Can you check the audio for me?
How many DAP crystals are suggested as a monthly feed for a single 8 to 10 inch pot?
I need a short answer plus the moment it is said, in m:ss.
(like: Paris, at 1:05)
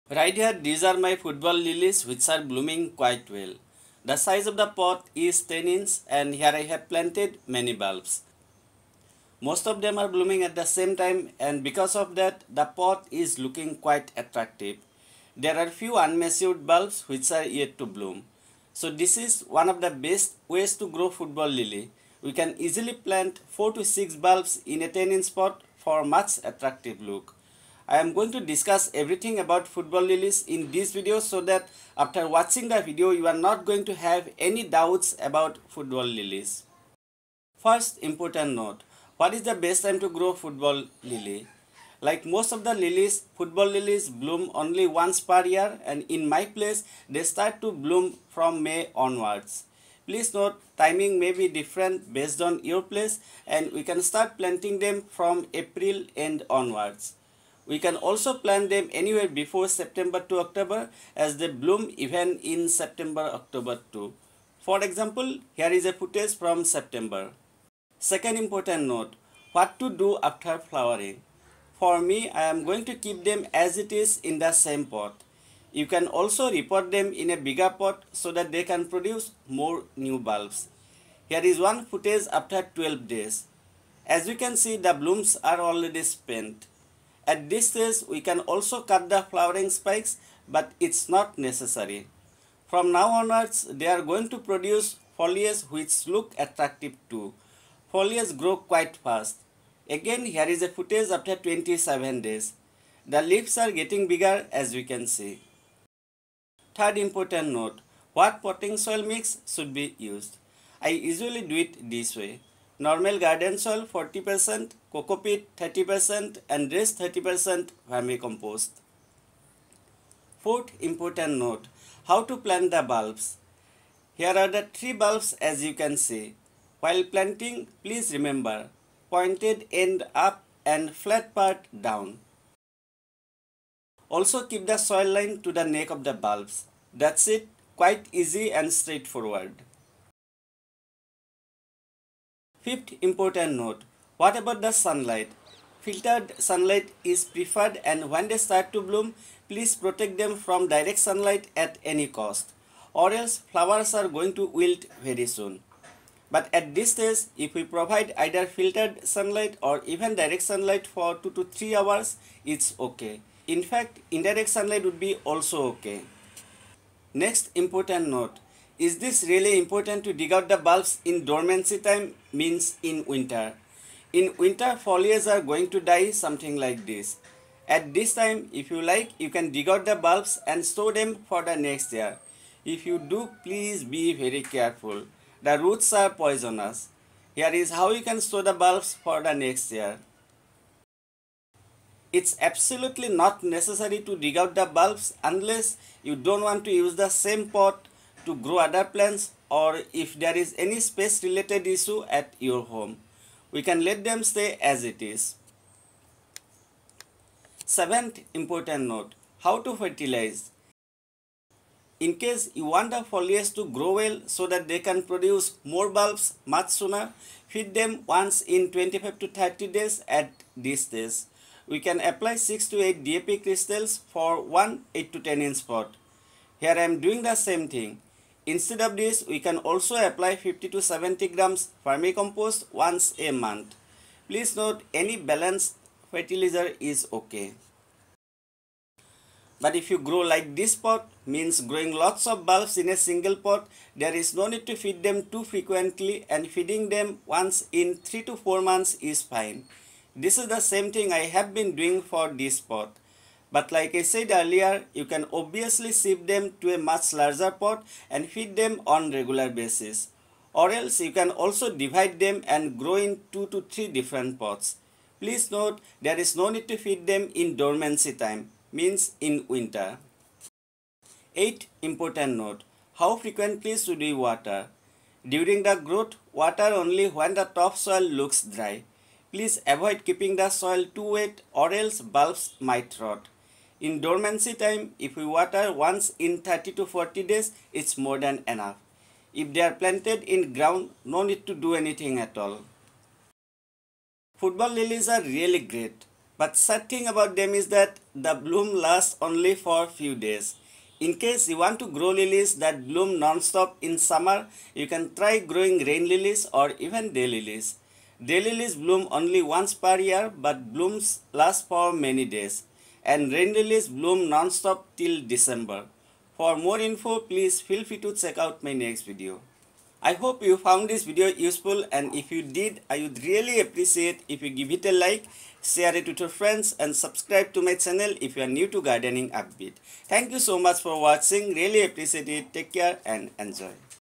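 6 to 8, at 3:42.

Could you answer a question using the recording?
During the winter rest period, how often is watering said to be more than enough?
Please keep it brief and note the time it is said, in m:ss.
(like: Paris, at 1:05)
once in 30 to 40 days, at 4:45.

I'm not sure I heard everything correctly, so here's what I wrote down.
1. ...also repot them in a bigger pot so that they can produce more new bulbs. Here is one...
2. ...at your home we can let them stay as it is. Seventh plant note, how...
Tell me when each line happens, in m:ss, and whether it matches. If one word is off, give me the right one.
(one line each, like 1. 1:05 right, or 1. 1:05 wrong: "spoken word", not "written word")
1. 1:16 right
2. 3:22 wrong: "important", not "plant".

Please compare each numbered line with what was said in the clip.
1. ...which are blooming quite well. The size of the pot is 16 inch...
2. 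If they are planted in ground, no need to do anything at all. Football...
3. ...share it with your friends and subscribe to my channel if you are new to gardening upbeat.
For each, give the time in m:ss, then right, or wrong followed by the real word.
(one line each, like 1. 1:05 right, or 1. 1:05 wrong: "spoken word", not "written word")
1. 0:02 wrong: "10", not "16"
2. 4:49 right
3. 5:25 right.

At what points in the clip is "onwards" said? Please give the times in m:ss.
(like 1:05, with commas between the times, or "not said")
0:48, 0:56, 1:33.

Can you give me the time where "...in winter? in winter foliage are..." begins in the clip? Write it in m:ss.
2:52.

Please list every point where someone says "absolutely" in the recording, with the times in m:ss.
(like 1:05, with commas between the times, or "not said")
3:12.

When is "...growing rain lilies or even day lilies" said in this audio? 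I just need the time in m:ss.
5:05.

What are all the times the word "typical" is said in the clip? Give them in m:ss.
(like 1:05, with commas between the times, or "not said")
not said.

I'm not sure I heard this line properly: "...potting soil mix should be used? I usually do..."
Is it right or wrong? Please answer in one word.
right.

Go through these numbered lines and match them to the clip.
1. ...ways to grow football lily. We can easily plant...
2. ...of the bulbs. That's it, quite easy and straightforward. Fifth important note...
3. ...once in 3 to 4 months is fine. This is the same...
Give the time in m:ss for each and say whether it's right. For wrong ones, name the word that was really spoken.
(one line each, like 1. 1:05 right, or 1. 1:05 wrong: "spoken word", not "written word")
1. 0:20 right
2. 2:15 right
3. 4:07 right.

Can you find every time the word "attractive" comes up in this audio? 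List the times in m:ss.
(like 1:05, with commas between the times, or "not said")
0:14, 0:26, 1:36.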